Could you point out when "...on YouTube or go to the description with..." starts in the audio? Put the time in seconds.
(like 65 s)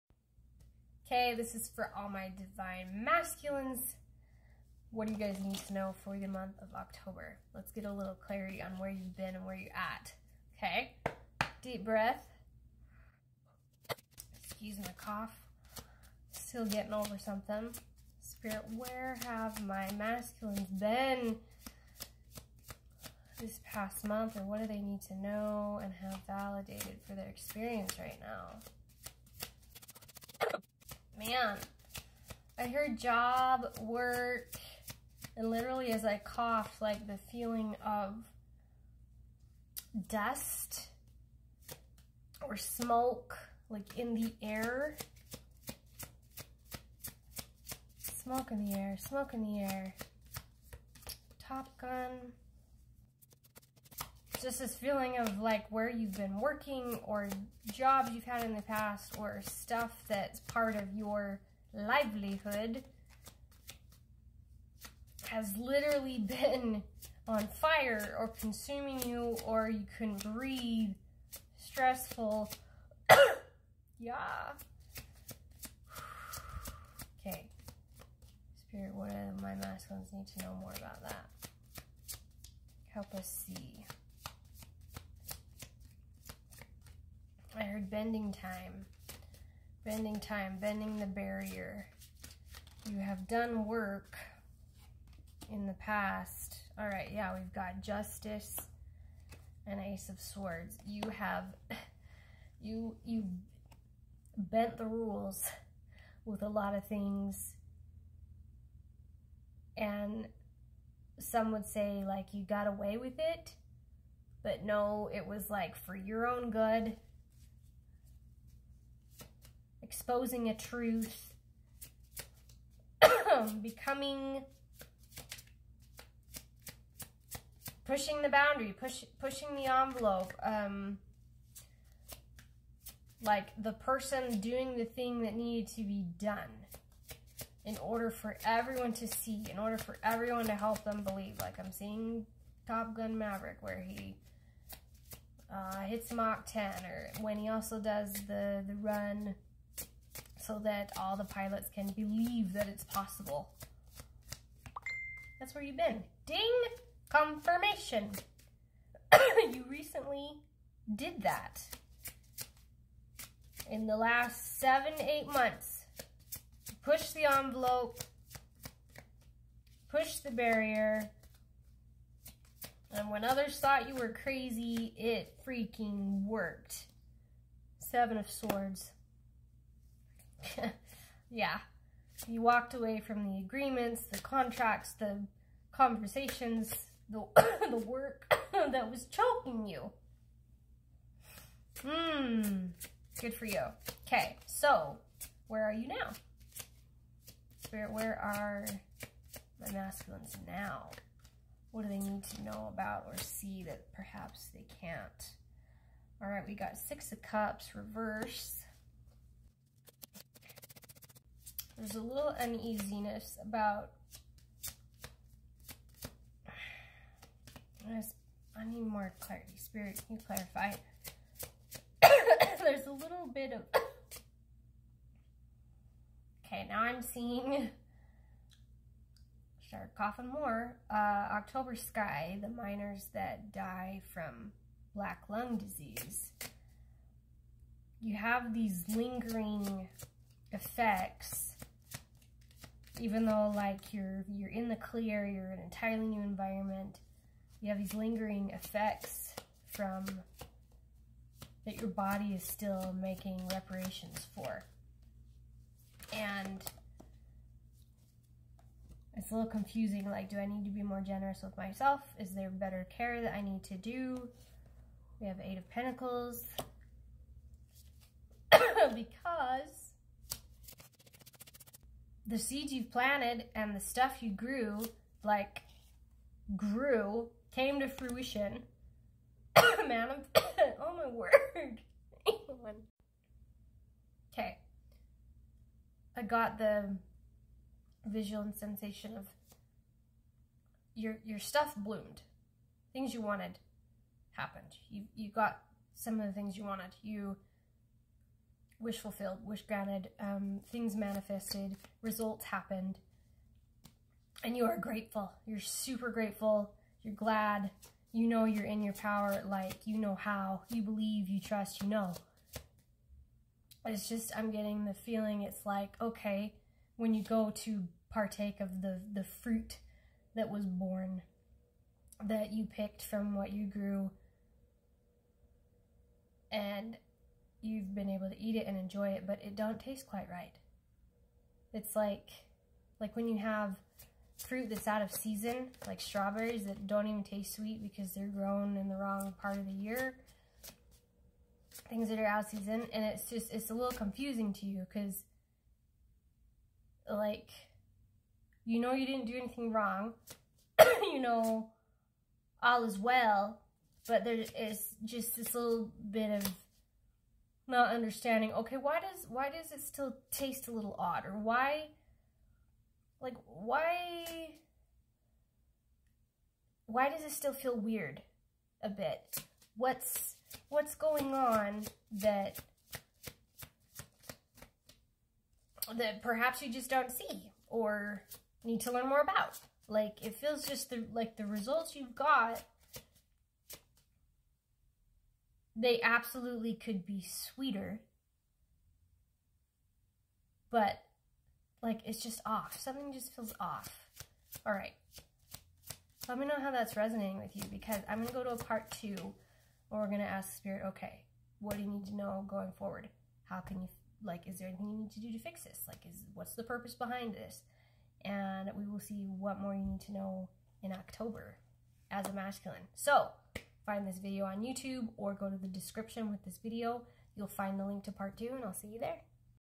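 414 s.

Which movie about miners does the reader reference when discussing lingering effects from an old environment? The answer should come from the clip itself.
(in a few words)
October Sky.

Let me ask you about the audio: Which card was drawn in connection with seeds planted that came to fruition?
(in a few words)
Eight of Pentacles.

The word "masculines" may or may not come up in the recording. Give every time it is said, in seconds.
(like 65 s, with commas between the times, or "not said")
3 s, 19 s, 79 s, 199 s, 412 s.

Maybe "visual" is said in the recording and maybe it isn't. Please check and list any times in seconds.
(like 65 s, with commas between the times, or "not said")
288 s.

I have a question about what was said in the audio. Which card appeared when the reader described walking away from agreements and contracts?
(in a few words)
Seven of Swords.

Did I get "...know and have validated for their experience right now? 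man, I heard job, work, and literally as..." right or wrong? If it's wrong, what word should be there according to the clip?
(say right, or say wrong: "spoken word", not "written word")
right.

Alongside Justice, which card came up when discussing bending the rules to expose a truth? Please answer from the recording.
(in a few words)
Ace of Swords.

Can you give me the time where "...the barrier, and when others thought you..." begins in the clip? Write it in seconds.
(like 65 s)
170 s.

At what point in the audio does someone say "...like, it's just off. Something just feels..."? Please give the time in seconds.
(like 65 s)
391 s.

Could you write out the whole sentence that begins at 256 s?
And it's a little confusing, like, do I need to be more generous with myself?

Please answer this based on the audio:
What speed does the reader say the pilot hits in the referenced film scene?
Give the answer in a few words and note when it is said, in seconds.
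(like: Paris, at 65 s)
Mach 10, at 146 s.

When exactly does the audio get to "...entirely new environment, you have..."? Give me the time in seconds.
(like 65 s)
245 s.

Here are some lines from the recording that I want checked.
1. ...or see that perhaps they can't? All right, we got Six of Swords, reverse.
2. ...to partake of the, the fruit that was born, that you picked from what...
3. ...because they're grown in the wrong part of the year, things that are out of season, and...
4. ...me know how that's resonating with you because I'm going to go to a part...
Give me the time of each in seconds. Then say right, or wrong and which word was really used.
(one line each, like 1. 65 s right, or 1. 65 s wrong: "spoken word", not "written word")
1. 203 s wrong: "Cups", not "Swords"
2. 317 s right
3. 337 s right
4. 396 s right.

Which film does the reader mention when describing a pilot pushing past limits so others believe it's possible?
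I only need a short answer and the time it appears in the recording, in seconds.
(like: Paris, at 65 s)
Top Gun Maverick, at 142 s.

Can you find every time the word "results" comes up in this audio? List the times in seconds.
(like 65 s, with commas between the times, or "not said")
302 s, 381 s.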